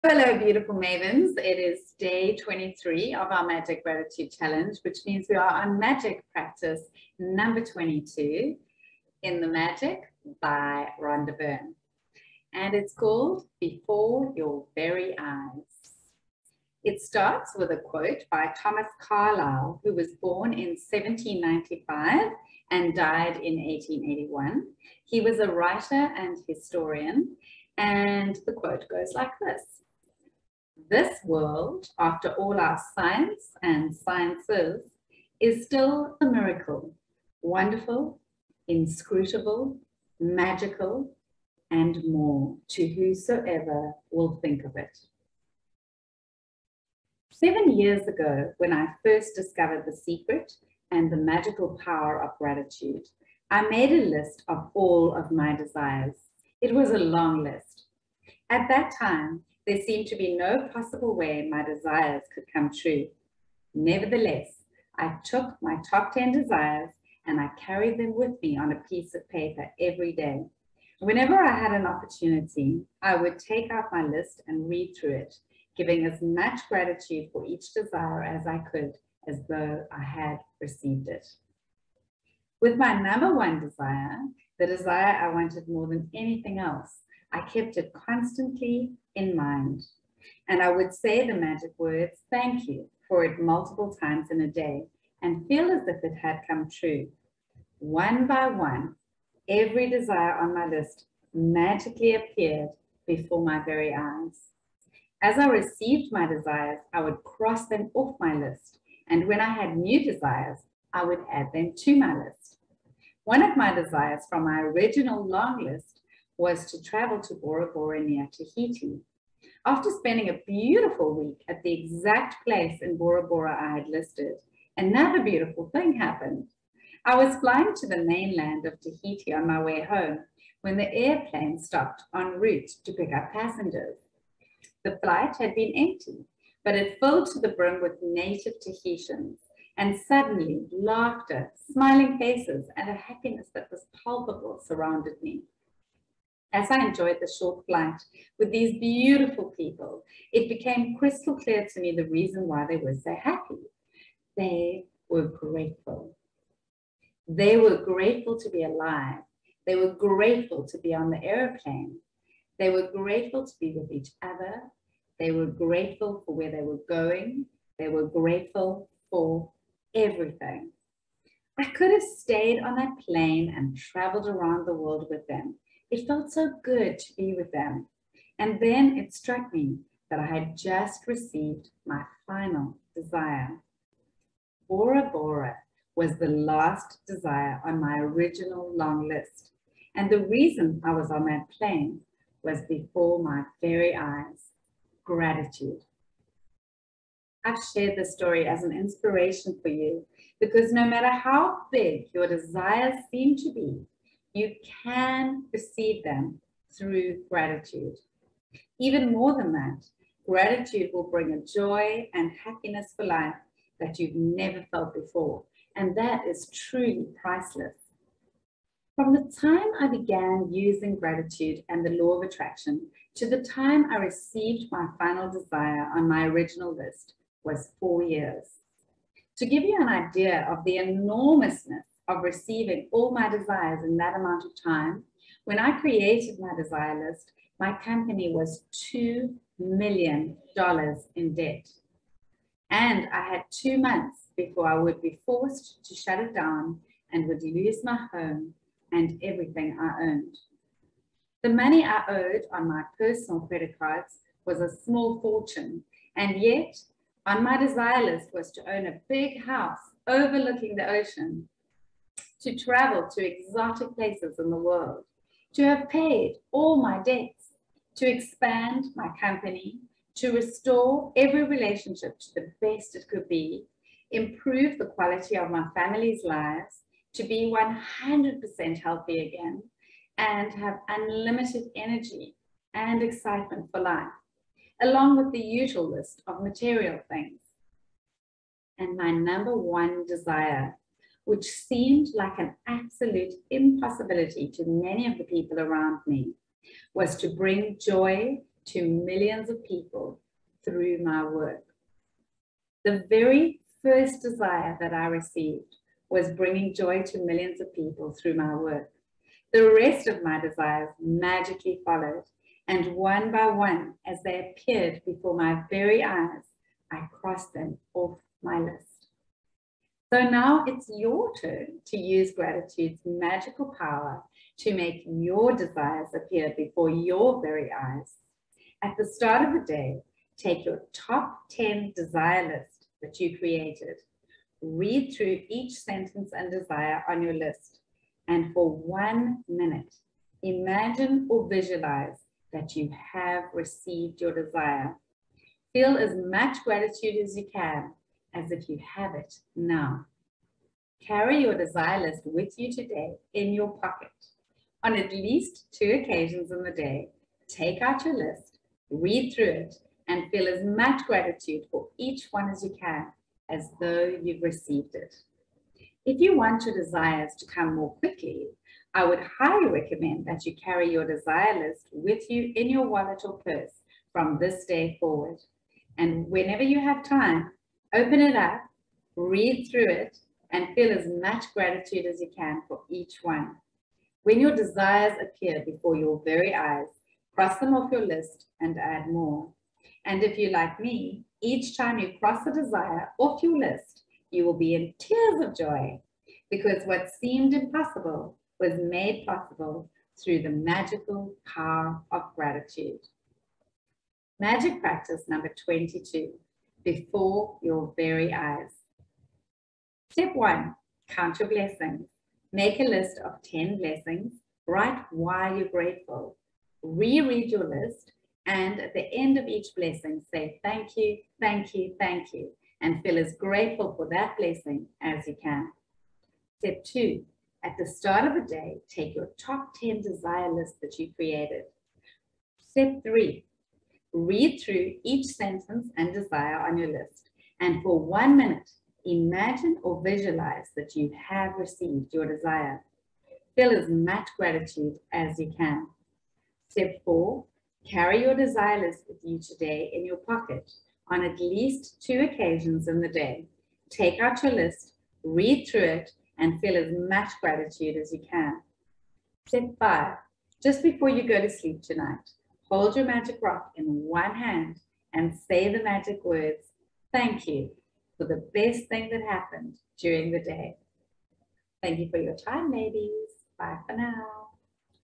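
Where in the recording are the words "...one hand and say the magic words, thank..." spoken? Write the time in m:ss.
7:43.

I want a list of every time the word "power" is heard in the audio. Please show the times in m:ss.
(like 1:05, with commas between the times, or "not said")
0:51, 5:23, 6:41.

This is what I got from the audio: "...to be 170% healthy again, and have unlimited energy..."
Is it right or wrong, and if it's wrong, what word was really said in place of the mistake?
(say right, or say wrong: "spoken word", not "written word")
wrong: "100", not "170".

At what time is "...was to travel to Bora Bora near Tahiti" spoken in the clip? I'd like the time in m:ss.
1:56.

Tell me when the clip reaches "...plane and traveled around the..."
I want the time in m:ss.
2:53.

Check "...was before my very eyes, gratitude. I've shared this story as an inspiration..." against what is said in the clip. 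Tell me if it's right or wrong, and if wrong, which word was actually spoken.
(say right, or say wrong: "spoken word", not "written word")
right.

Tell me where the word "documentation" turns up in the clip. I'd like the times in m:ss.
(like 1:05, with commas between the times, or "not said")
not said.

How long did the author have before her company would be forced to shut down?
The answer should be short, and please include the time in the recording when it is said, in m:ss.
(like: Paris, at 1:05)
2 months, at 4:03.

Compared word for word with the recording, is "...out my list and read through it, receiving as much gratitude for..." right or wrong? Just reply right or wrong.
wrong.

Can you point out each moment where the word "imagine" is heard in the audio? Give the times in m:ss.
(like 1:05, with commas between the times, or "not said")
5:40, 7:19.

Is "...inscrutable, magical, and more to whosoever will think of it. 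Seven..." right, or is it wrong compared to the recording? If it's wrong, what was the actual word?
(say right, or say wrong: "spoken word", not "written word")
right.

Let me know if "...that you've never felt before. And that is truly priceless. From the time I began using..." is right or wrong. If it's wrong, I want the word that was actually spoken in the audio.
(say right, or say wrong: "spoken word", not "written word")
right.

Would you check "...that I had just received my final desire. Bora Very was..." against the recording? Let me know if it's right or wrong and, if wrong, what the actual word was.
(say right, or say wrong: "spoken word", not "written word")
wrong: "Bora", not "Very".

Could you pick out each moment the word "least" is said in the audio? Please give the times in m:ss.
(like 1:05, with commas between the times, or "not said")
5:55, 7:31.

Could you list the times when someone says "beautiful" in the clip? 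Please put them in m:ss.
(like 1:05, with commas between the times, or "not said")
0:00, 2:00, 2:05, 2:28.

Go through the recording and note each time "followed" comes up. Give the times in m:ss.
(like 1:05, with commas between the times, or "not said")
5:11.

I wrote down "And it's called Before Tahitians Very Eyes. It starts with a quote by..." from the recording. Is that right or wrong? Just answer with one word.
wrong.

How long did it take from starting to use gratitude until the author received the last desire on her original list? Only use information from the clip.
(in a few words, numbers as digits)
4 years.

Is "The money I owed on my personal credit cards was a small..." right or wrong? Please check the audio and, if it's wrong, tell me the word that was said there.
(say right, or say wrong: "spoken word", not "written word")
right.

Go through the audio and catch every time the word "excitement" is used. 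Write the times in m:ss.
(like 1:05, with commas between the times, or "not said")
4:43.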